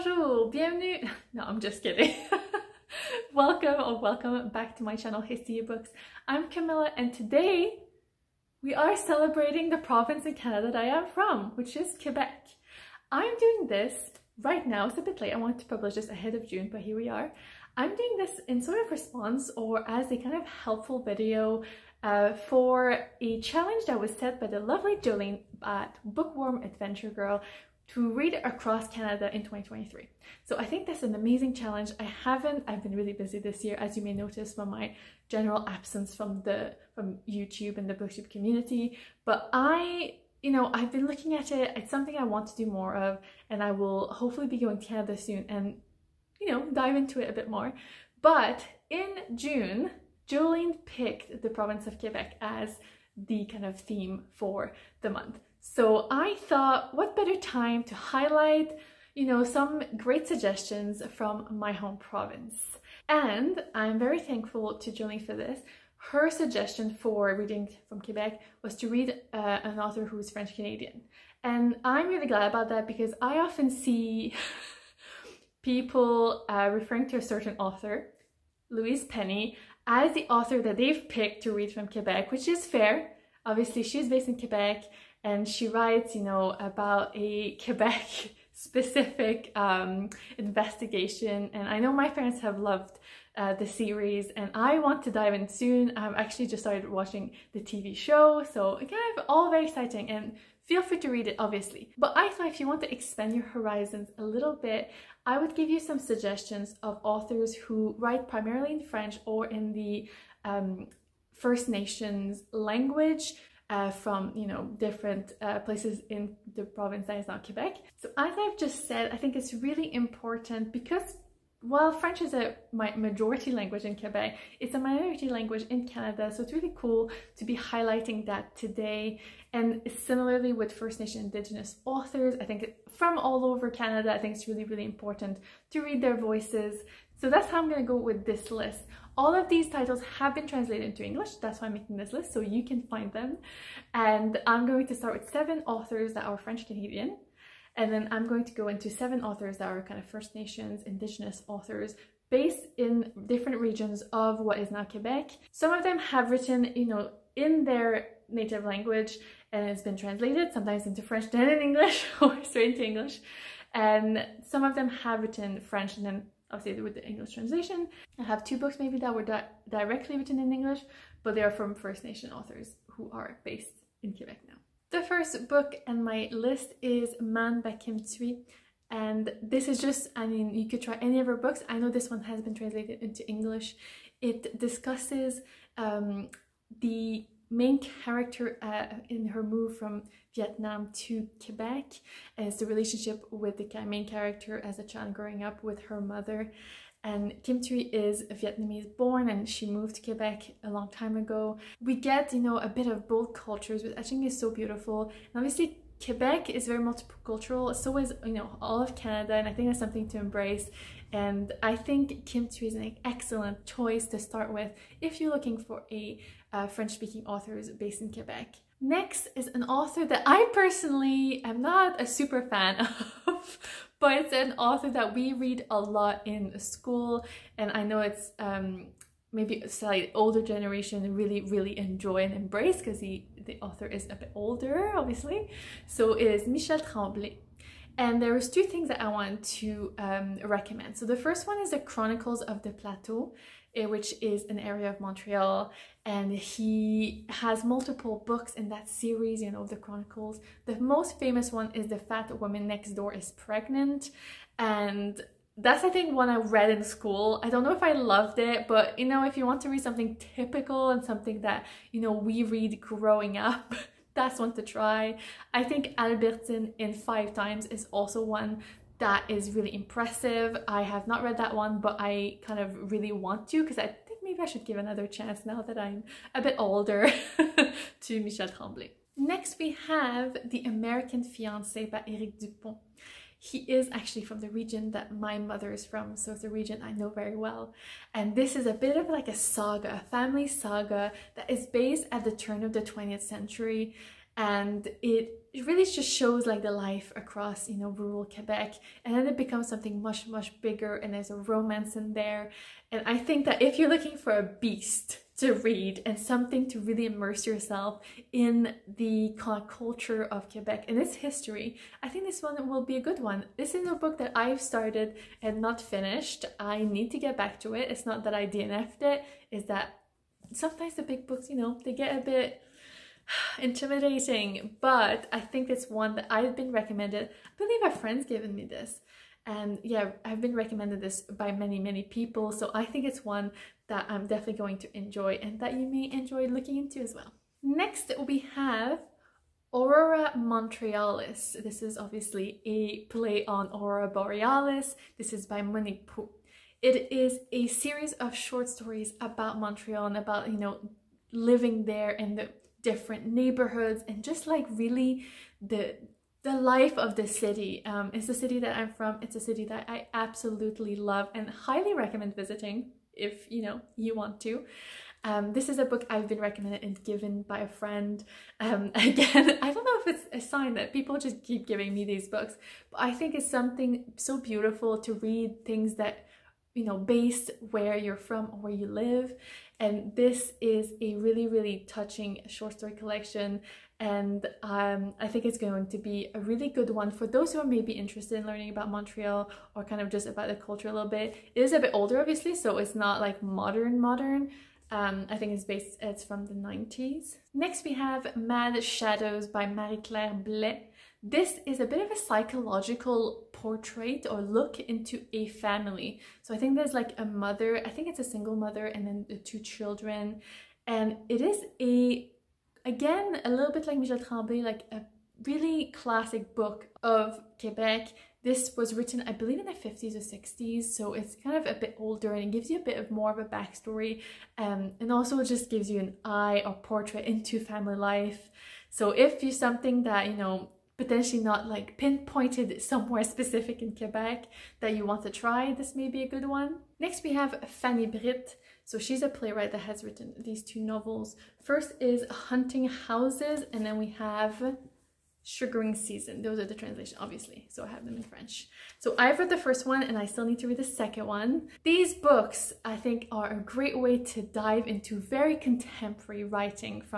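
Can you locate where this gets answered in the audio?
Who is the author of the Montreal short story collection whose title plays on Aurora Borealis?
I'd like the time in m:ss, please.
5:45.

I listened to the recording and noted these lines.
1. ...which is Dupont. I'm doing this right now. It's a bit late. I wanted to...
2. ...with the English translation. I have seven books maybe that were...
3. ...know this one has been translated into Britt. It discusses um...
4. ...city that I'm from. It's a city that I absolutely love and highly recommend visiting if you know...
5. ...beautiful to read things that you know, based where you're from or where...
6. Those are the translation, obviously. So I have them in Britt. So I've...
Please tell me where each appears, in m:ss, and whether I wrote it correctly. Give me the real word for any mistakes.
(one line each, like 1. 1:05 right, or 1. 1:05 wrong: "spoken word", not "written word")
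1. 0:11 wrong: "Quebec", not "Dupont"
2. 2:46 wrong: "two", not "seven"
3. 3:01 wrong: "English", not "Britt"
4. 5:58 right
5. 6:14 right
6. 7:26 wrong: "French", not "Britt".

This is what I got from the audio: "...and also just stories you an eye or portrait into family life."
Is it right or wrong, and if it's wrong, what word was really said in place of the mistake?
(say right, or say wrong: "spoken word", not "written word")
wrong: "gives", not "stories".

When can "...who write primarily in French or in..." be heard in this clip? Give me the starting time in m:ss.
1:47.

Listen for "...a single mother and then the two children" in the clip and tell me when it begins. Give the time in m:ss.
6:48.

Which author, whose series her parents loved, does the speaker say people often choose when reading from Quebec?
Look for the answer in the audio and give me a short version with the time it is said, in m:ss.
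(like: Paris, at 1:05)
Louise Penny, at 1:18.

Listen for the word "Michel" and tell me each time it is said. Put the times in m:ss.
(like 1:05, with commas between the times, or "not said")
3:56, 4:38, 6:53.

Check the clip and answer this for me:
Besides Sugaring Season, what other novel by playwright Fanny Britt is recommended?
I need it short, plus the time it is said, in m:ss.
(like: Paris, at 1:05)
Hunting Houses, at 7:22.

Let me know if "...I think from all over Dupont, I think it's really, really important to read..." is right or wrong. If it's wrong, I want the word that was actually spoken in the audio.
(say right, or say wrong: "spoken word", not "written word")
wrong: "Canada", not "Dupont".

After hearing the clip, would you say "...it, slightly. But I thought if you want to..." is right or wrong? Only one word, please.
wrong.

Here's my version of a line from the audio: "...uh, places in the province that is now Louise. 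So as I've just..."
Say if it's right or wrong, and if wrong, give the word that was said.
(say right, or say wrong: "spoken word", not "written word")
wrong: "Quebec", not "Louise".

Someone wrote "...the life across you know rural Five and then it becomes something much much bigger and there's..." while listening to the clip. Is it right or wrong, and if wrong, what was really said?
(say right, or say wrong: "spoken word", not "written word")
wrong: "Quebec", not "Five".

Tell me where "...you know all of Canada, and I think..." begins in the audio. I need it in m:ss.
3:28.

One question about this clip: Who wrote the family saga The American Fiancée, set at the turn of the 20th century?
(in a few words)
Eric Dupont.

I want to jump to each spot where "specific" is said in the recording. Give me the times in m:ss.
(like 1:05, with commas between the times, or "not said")
1:28, 7:13.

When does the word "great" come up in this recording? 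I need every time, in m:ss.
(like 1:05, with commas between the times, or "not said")
0:59, 7:33.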